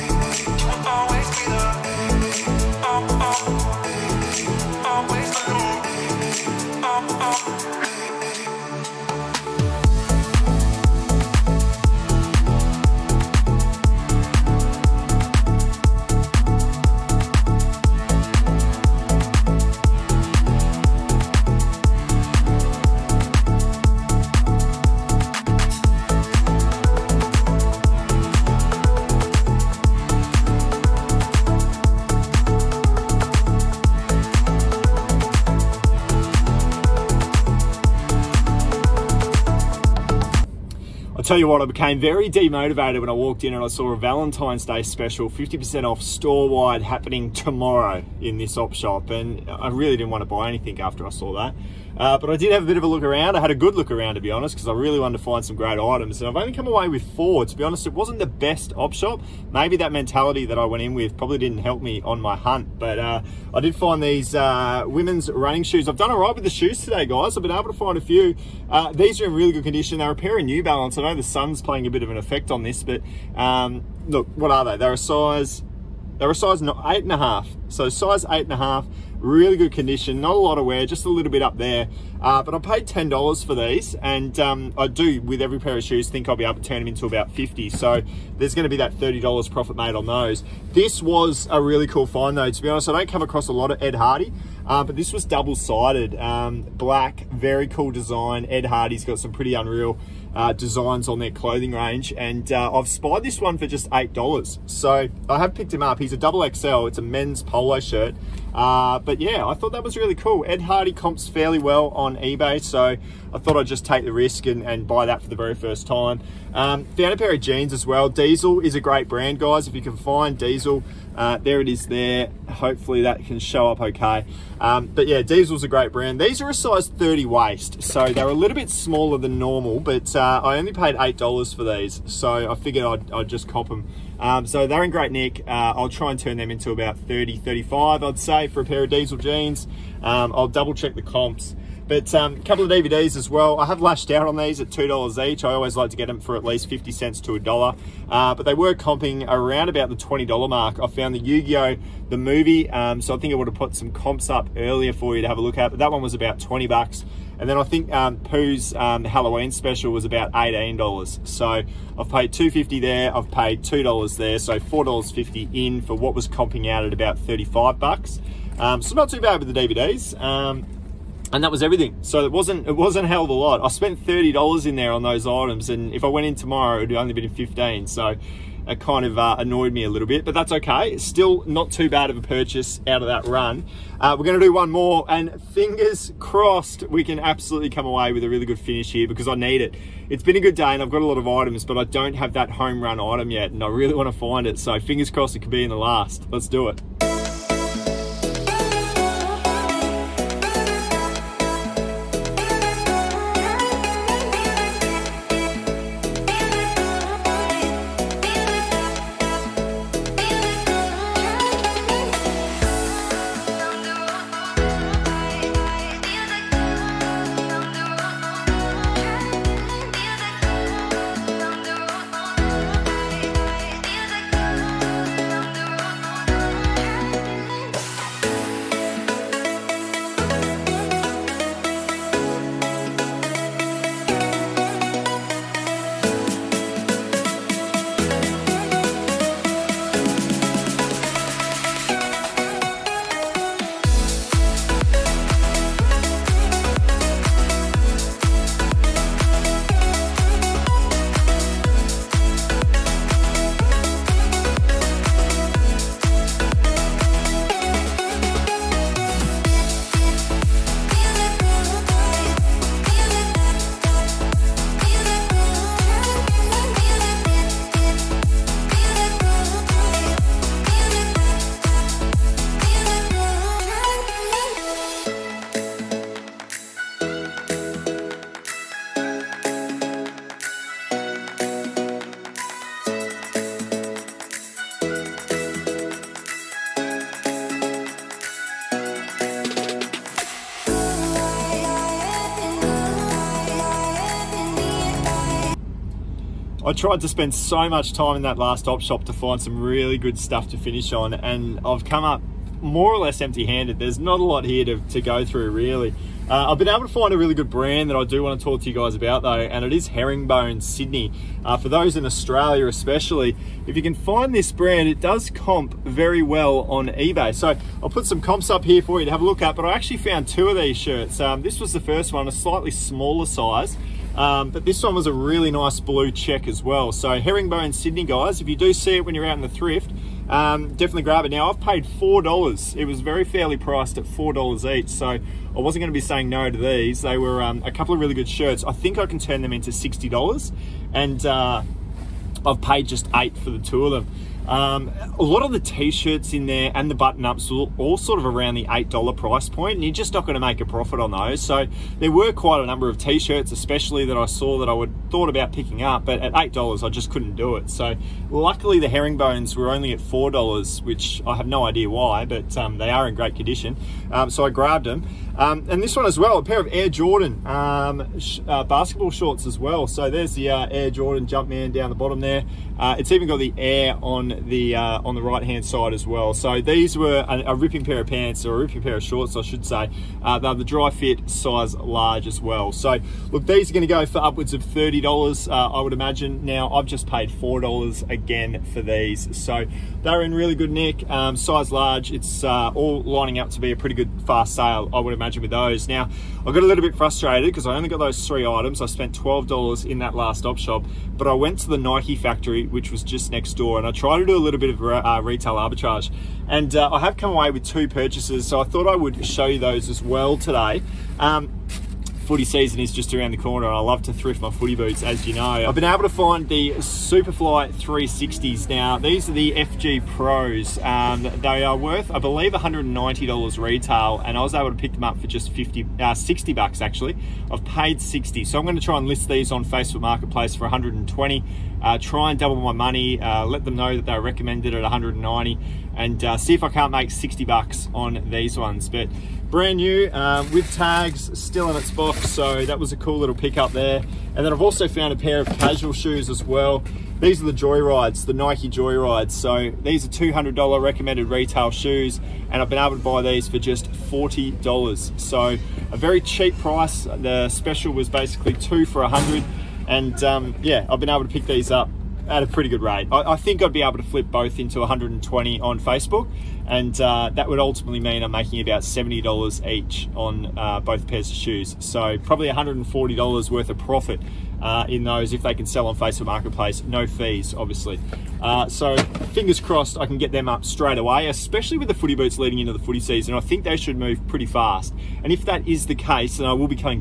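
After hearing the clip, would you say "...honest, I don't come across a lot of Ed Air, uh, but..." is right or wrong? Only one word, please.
wrong.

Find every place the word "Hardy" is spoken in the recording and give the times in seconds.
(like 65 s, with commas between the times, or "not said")
93 s, 98 s, 110 s.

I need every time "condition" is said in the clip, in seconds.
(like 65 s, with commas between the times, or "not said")
69 s, 79 s, 363 s.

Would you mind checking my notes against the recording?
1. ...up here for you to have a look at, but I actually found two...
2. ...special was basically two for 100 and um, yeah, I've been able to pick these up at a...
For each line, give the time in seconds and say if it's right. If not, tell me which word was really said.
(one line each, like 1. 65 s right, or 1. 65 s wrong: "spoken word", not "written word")
1. 318 s right
2. 457 s right.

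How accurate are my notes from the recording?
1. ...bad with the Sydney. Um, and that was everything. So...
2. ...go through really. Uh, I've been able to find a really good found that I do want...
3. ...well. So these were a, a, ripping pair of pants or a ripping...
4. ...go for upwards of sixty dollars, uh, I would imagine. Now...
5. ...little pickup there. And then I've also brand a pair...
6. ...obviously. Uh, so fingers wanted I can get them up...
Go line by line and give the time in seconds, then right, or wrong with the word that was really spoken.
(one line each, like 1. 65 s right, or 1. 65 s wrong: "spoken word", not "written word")
1. 169 s wrong: "DVDs", not "Sydney"
2. 304 s wrong: "brand", not "found"
3. 376 s right
4. 383 s wrong: "thirty", not "sixty"
5. 443 s wrong: "found", not "brand"
6. 477 s wrong: "crossed", not "wanted".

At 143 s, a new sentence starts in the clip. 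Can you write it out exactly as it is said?
I have lashed out on these at $2 each.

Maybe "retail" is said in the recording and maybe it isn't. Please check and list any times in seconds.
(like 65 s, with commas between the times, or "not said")
405 s, 423 s, 451 s.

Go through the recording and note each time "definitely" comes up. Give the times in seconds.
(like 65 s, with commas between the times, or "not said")
330 s.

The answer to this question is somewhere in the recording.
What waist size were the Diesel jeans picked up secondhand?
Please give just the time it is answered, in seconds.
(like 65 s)
126 s.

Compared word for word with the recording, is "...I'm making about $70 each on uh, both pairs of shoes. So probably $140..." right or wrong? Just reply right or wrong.
right.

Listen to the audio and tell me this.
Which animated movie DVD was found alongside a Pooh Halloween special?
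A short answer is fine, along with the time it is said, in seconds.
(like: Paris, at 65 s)
Yu-Gi-Oh! the movie, at 151 s.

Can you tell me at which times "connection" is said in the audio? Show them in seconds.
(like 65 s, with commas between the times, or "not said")
not said.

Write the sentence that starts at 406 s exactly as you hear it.
And uh, I have come away with two purchases, so I thought I would show you those as well today.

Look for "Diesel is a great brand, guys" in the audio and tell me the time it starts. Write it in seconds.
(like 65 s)
118 s.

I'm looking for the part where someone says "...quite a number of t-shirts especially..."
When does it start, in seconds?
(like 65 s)
352 s.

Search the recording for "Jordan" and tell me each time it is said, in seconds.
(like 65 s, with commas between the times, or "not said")
366 s, 370 s.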